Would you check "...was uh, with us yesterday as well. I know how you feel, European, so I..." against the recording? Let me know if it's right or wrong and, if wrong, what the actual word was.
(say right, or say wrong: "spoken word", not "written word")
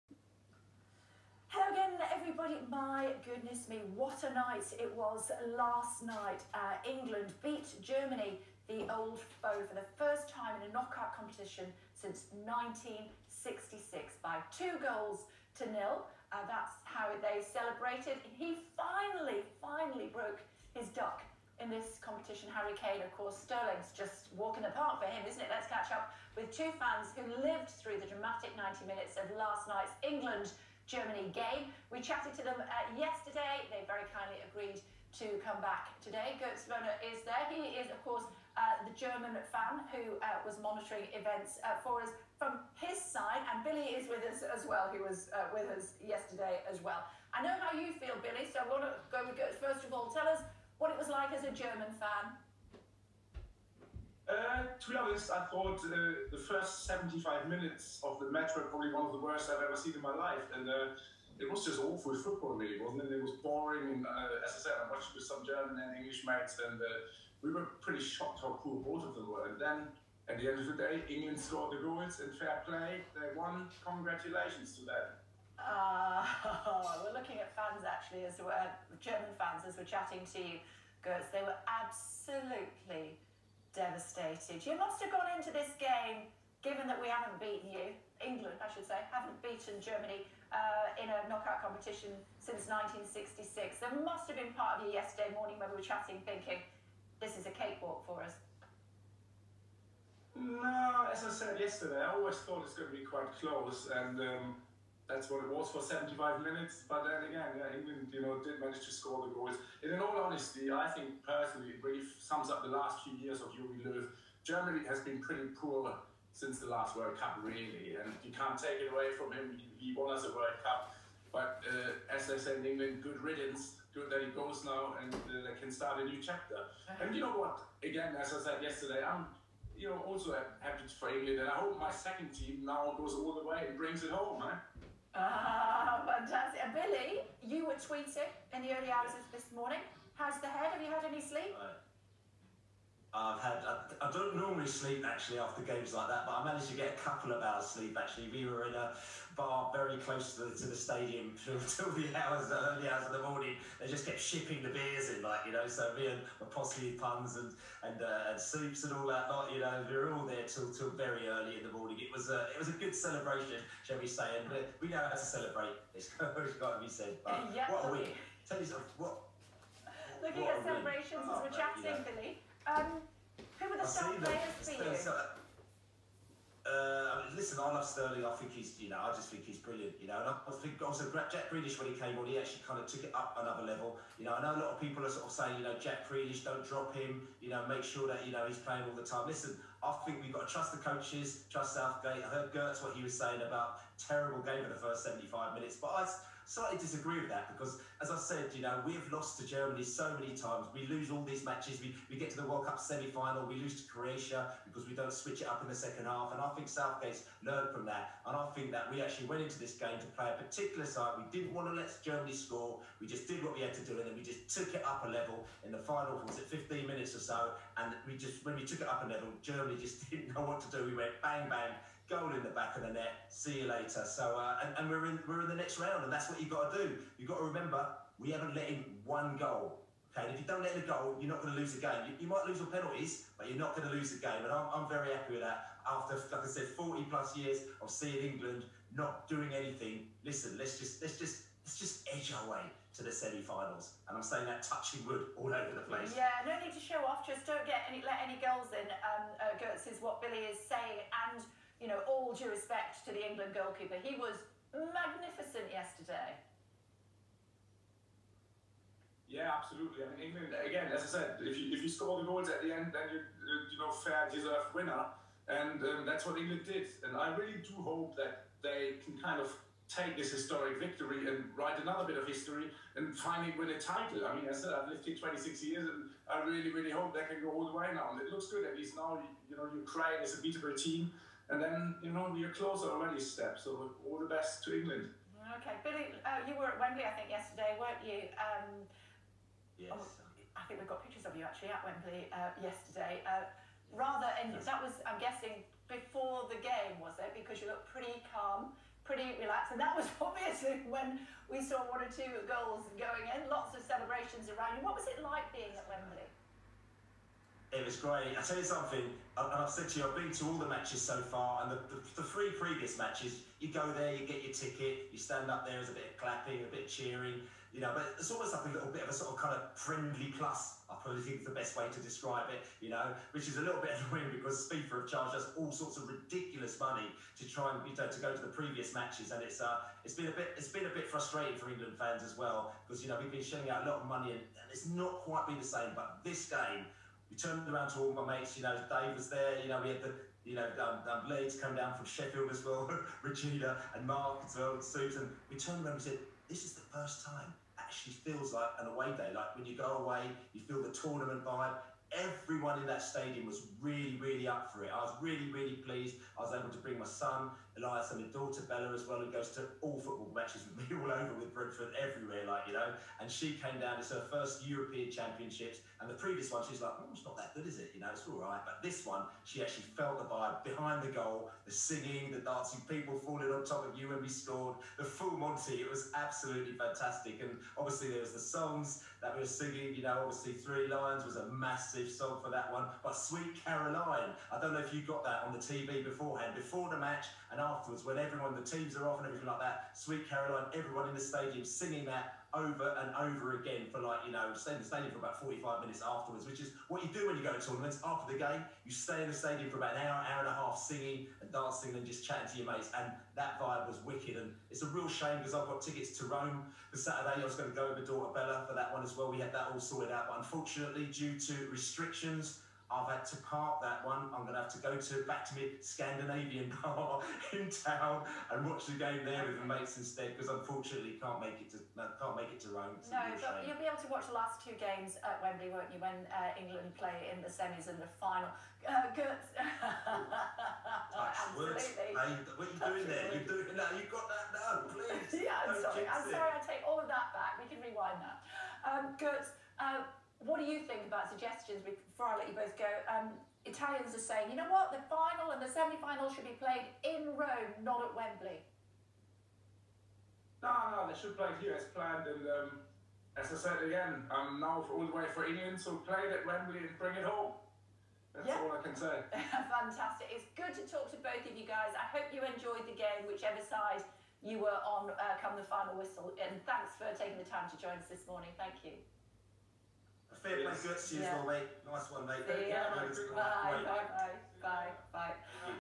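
wrong: "Billy", not "European".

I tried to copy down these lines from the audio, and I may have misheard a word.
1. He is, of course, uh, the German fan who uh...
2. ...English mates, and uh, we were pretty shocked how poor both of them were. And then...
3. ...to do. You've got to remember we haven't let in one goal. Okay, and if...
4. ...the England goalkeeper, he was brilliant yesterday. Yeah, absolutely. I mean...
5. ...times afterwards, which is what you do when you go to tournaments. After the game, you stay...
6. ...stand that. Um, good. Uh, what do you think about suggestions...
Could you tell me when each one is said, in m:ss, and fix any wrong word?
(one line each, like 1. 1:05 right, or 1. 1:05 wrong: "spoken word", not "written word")
1. 0:37 right
2. 1:05 right
3. 3:46 right
4. 4:13 wrong: "magnificent", not "brilliant"
5. 6:35 wrong: "minutes", not "times"
6. 7:17 wrong: "rewind", not "stand".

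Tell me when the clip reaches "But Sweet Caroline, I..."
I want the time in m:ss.
6:23.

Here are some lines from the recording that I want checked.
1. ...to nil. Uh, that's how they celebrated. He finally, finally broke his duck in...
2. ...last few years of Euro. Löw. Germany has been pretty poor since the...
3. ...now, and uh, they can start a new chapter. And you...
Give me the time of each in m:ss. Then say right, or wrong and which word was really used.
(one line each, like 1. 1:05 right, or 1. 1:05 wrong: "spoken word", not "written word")
1. 0:15 right
2. 1:52 right
3. 2:04 right.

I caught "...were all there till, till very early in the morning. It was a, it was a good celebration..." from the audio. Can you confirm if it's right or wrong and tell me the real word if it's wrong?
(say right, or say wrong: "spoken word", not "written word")
right.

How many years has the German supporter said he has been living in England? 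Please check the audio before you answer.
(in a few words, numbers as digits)
26.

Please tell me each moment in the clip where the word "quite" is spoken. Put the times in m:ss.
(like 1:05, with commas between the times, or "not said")
1:43, 5:35.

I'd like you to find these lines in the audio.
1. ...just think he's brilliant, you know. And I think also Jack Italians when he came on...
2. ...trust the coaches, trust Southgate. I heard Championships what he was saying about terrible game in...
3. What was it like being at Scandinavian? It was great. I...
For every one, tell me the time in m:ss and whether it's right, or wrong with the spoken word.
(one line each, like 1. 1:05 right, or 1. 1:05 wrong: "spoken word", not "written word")
1. 2:59 wrong: "Grealish", not "Italians"
2. 3:10 wrong: "Gotz", not "Championships"
3. 5:04 wrong: "Wembley", not "Scandinavian".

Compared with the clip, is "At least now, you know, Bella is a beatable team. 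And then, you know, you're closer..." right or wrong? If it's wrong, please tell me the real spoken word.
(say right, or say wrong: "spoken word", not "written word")
wrong: "Ukraine", not "Bella".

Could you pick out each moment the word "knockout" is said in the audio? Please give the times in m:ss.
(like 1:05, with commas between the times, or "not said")
0:10, 1:31.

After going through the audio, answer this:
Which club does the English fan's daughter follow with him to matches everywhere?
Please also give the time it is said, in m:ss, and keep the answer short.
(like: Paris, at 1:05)
Brentford, at 6:01.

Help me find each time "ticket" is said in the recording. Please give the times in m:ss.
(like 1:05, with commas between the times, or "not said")
5:14, 6:45.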